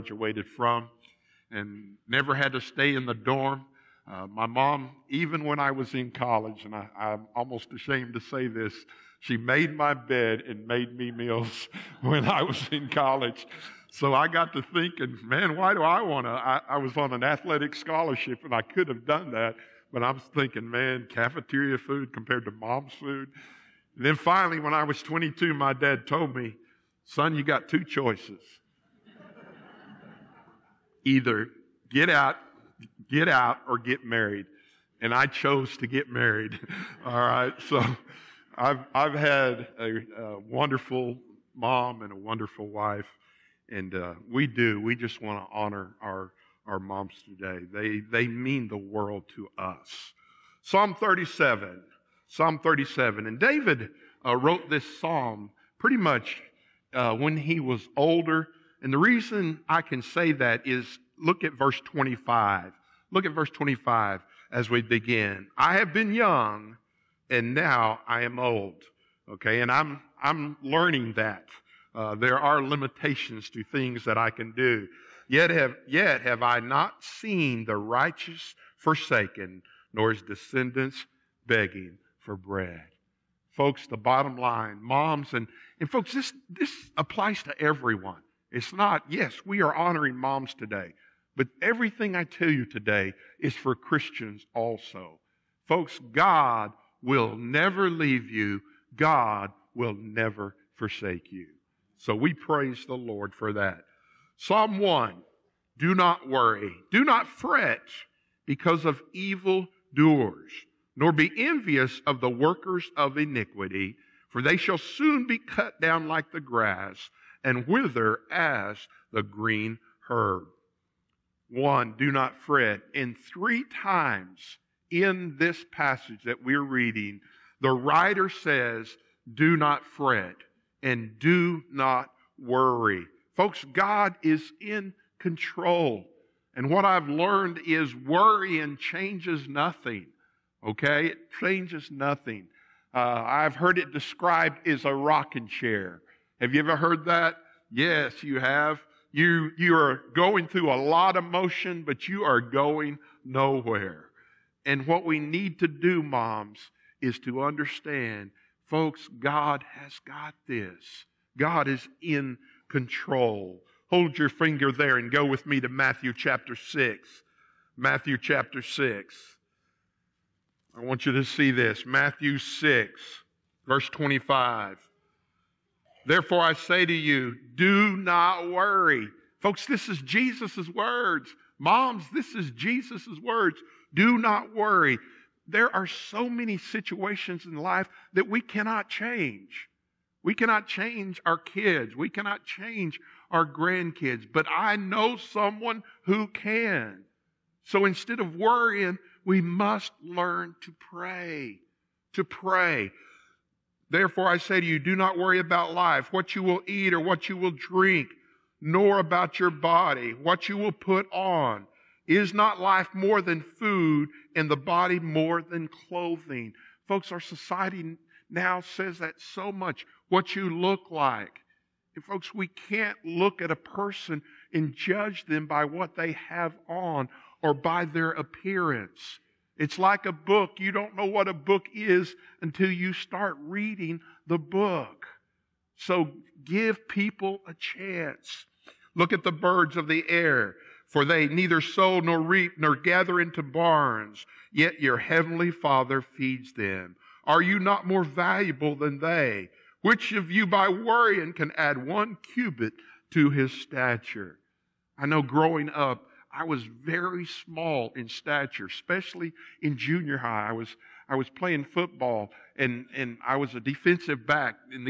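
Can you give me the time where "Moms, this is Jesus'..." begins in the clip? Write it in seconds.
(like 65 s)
181 s.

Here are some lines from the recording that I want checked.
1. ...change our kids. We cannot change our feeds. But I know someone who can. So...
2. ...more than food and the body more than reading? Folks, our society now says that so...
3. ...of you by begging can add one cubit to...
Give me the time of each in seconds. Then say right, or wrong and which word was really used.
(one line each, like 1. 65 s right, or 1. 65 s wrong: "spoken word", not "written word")
1. 190 s wrong: "grandkids", not "feeds"
2. 212 s wrong: "clothing", not "reading"
3. 250 s wrong: "worrying", not "begging".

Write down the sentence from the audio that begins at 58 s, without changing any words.
And the reason I can say that is look at verse 25.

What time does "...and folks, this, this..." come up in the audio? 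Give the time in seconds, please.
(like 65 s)
85 s.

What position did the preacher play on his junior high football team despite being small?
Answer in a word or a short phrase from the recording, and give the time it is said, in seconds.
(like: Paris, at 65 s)
Defensive back, at 263 s.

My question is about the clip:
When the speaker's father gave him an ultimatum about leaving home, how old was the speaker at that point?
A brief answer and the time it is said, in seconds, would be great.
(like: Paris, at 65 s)
22, at 25 s.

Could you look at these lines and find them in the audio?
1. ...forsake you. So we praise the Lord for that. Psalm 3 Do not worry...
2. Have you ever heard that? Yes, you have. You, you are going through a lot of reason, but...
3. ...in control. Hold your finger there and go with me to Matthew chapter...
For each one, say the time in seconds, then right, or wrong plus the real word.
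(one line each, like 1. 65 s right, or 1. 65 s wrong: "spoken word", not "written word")
1. 100 s wrong: "1", not "3"
2. 146 s wrong: "motion", not "reason"
3. 162 s right.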